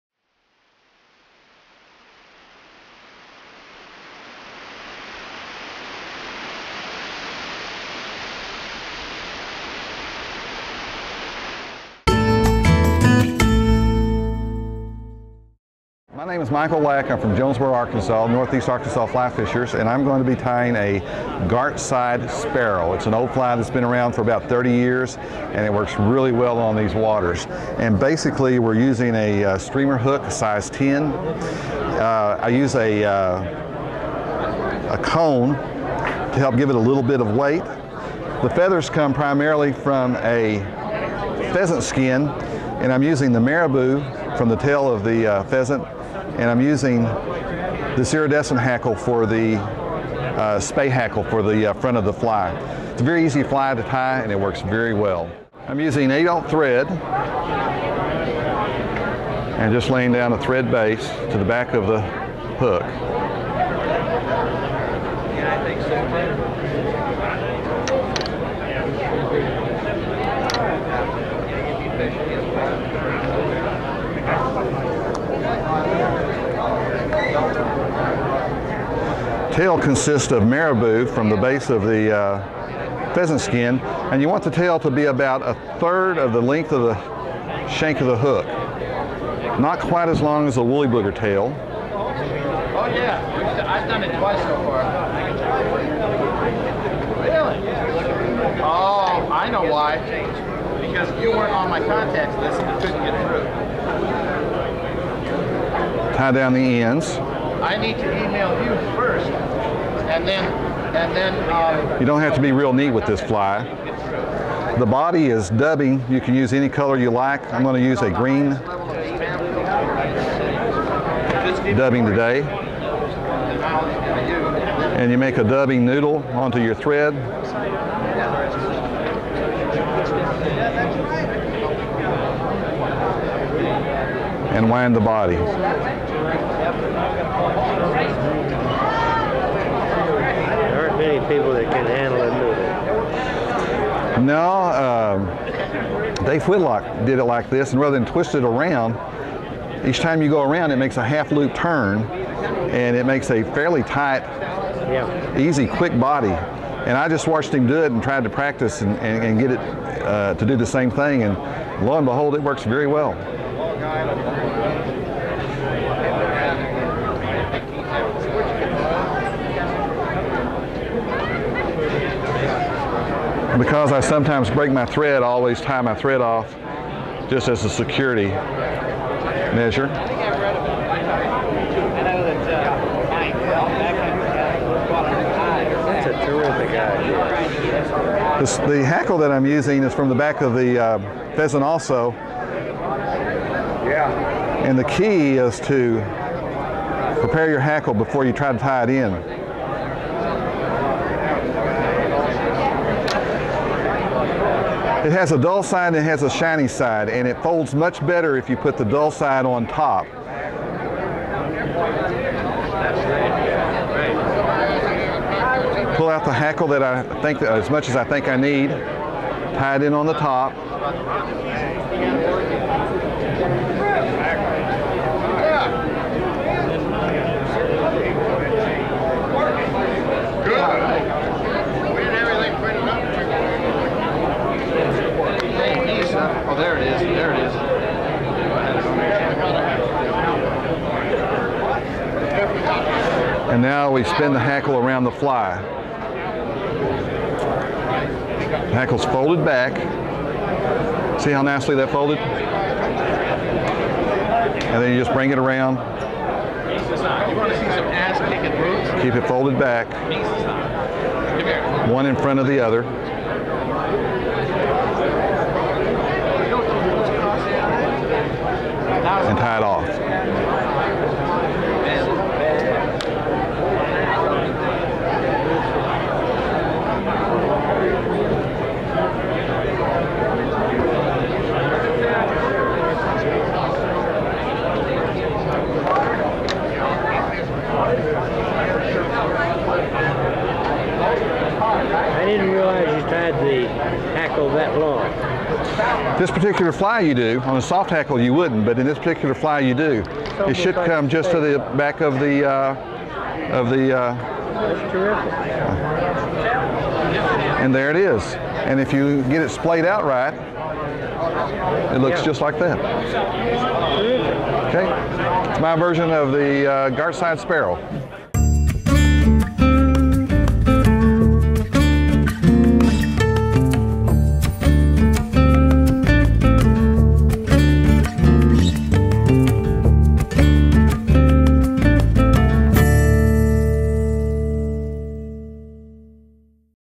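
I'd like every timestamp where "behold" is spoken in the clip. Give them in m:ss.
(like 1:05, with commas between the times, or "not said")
2:42.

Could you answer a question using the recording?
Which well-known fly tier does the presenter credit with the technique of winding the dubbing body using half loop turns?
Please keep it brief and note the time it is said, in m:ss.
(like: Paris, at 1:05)
Dave Whitlock, at 2:26.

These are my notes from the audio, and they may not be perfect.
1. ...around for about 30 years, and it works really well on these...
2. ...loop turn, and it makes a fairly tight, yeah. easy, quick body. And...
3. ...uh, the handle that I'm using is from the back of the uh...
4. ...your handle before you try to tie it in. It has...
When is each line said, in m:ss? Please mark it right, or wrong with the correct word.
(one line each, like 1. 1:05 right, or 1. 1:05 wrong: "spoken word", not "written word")
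1. 0:23 right
2. 2:31 right
3. 3:08 wrong: "hackle", not "handle"
4. 3:17 wrong: "hackle", not "handle".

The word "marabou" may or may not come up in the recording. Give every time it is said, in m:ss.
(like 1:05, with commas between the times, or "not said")
0:43, 1:20.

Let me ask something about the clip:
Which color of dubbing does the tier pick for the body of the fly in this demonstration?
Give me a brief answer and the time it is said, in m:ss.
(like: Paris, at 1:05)
green, at 1:58.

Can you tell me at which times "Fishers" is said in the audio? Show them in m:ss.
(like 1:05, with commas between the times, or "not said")
0:19.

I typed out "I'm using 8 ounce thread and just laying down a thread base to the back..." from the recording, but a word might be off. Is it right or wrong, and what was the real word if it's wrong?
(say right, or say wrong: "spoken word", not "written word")
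right.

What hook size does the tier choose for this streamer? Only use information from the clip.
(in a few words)
10.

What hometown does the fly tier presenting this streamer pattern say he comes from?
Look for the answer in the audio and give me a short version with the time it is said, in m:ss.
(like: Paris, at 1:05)
Jonesboro, Arkansas, at 0:17.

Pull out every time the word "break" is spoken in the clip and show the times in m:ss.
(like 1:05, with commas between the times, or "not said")
2:54.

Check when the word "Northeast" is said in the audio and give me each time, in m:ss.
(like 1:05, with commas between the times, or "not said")
0:18.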